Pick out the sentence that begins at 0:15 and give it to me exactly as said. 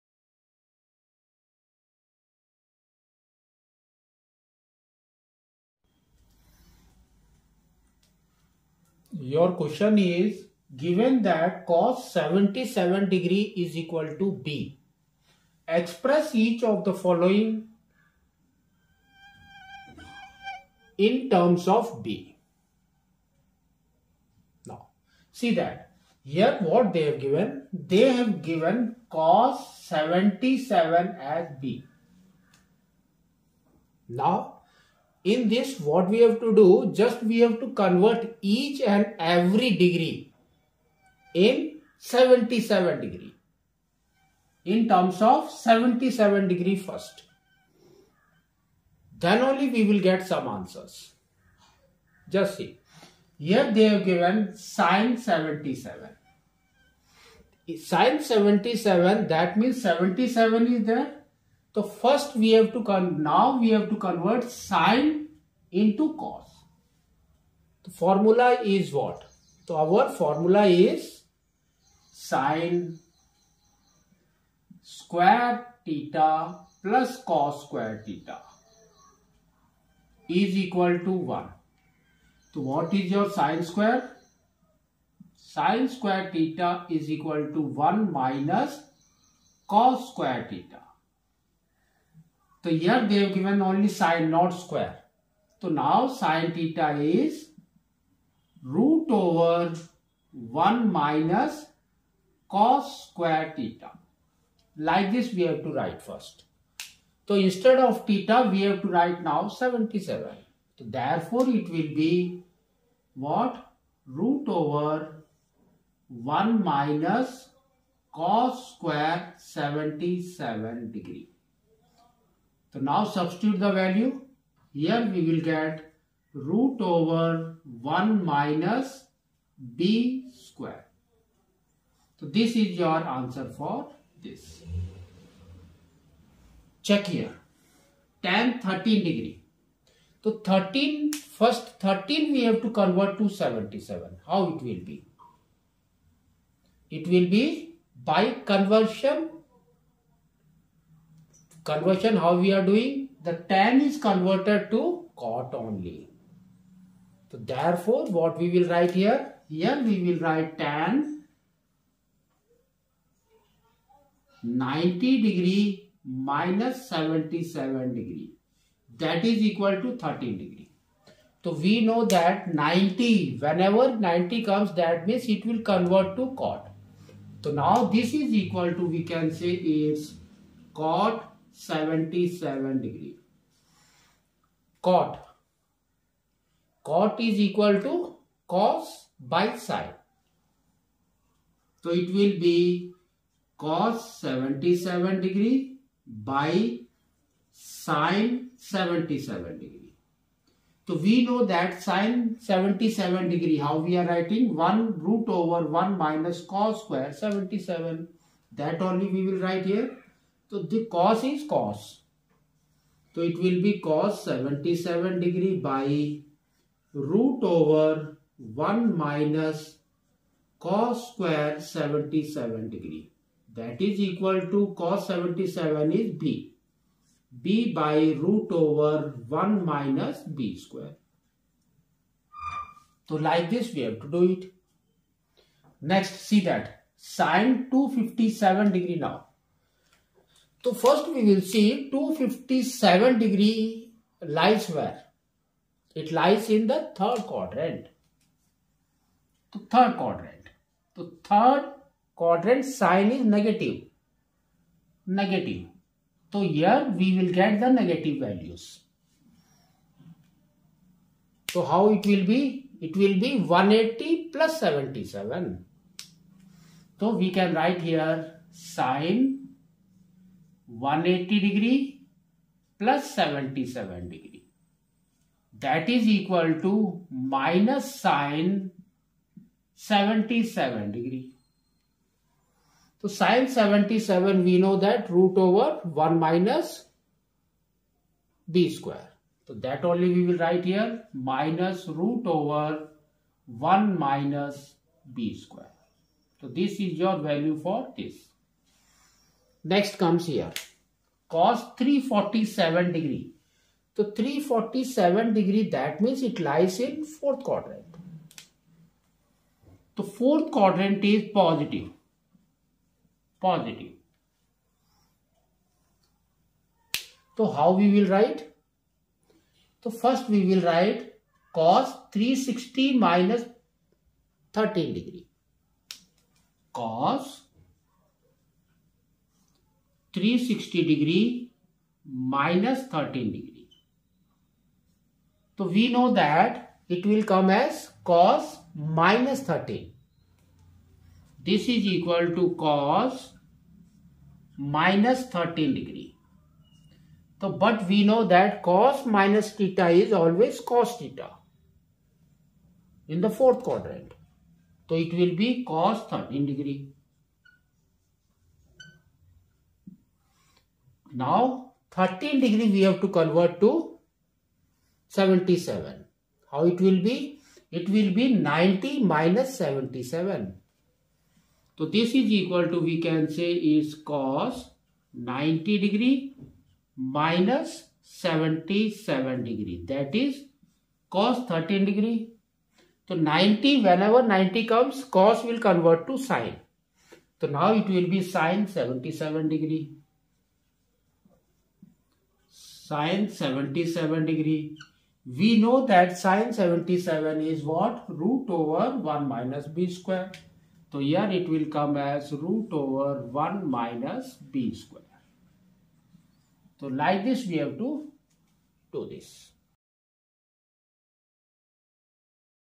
Express each of the following in terms of B.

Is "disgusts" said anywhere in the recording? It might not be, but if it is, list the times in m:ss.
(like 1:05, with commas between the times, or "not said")
not said.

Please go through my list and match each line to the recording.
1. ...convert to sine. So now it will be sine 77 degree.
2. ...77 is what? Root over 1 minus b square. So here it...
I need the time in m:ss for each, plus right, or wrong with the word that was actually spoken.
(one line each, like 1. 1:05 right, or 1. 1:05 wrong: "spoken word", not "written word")
1. 6:25 right
2. 6:36 right.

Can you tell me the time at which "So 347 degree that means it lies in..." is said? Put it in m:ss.
5:03.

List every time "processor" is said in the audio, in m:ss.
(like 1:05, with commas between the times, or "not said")
not said.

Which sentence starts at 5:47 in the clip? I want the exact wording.
So but we know that cos minus theta is always cos theta in the fourth quadrant.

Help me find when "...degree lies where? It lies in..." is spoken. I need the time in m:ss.
4:03.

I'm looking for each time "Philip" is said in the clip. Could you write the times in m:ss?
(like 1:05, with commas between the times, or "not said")
not said.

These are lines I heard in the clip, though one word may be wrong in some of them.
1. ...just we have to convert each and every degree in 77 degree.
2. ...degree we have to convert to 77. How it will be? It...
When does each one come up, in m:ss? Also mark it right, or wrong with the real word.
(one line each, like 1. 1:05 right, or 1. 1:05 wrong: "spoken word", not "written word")
1. 0:36 right
2. 6:02 right.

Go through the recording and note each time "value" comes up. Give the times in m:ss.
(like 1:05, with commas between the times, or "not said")
2:03, 4:18, 4:57.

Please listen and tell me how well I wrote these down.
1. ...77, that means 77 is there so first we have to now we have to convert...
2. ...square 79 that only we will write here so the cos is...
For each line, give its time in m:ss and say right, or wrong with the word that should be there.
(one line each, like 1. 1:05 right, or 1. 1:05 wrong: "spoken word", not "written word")
1. 0:58 right
2. 3:26 wrong: "77", not "79".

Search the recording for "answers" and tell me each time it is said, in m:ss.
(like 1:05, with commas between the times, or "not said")
0:50, 2:13.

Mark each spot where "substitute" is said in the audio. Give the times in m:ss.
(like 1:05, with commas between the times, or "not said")
2:03.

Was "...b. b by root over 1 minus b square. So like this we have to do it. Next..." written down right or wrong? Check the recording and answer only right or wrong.
right.